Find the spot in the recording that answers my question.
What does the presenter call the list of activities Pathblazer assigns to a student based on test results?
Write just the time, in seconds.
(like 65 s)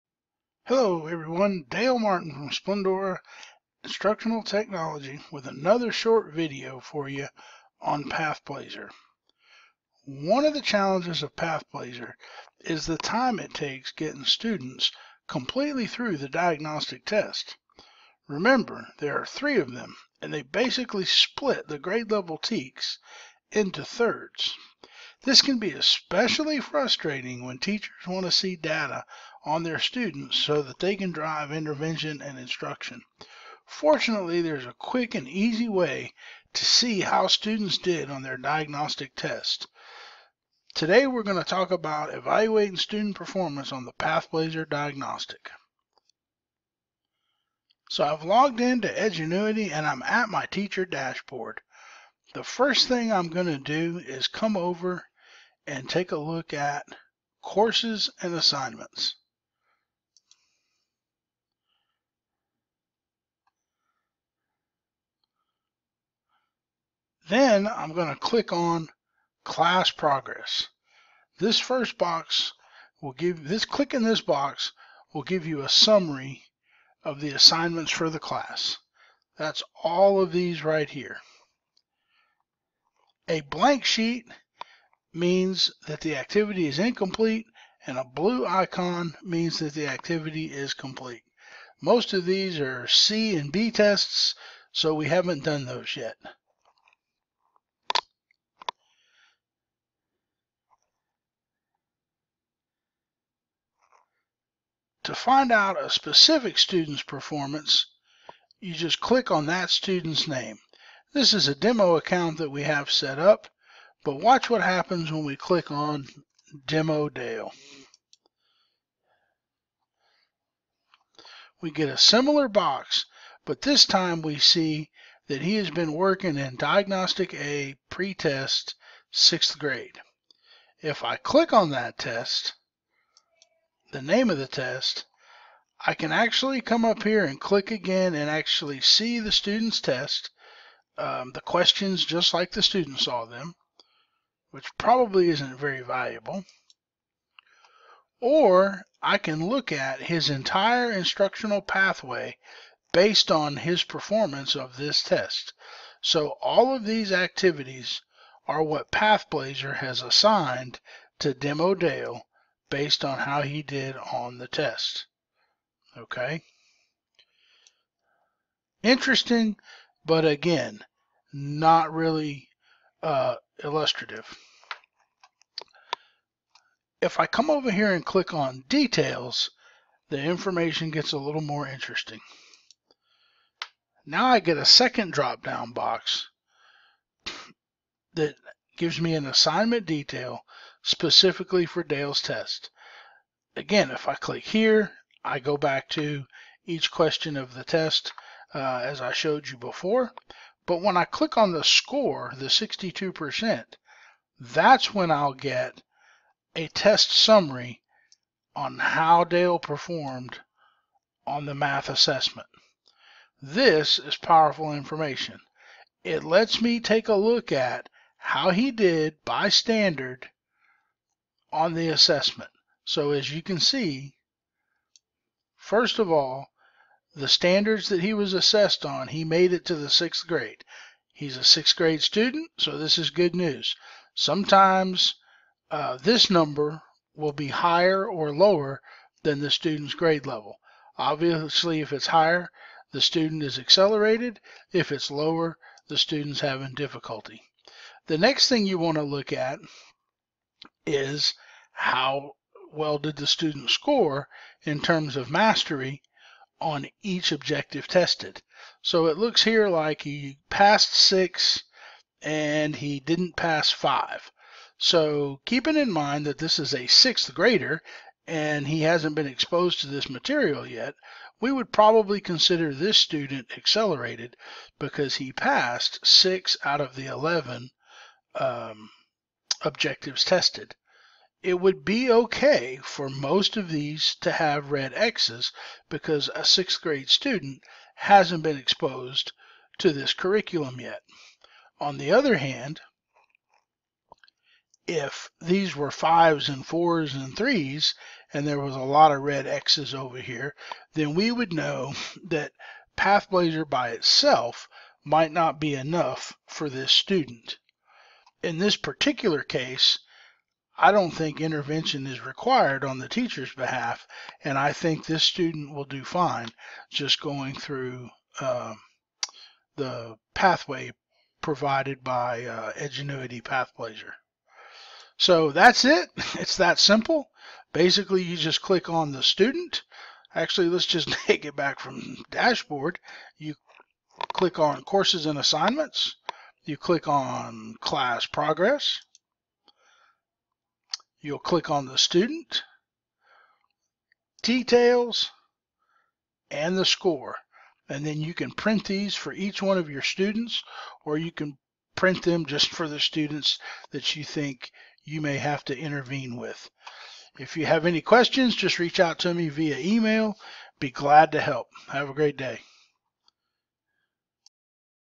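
150 s.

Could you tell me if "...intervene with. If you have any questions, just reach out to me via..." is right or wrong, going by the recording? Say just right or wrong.
right.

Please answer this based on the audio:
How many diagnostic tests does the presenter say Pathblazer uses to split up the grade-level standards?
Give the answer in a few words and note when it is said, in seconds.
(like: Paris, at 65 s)
3, at 19 s.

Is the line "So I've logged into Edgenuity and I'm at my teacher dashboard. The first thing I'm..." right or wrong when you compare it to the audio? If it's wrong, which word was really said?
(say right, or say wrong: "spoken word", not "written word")
right.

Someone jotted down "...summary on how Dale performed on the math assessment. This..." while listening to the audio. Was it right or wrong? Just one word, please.
right.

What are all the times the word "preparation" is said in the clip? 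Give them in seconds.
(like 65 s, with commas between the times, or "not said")
not said.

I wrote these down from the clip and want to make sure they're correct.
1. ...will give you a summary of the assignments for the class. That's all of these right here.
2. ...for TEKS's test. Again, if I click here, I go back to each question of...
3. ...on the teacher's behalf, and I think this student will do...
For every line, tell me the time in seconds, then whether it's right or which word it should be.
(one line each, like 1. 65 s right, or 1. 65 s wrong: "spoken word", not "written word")
1. 75 s right
2. 191 s wrong: "Dale", not "TEKS"
3. 312 s right.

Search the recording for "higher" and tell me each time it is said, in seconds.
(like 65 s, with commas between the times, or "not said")
237 s, 242 s.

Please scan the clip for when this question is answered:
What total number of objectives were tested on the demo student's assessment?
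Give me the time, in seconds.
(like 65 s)
277 s.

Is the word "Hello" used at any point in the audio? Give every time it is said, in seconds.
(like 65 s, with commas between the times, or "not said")
0 s.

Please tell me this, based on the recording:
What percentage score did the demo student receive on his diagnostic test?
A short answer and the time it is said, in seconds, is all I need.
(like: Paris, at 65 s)
62%, at 202 s.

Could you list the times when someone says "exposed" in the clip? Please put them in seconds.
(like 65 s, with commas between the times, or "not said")
269 s, 288 s.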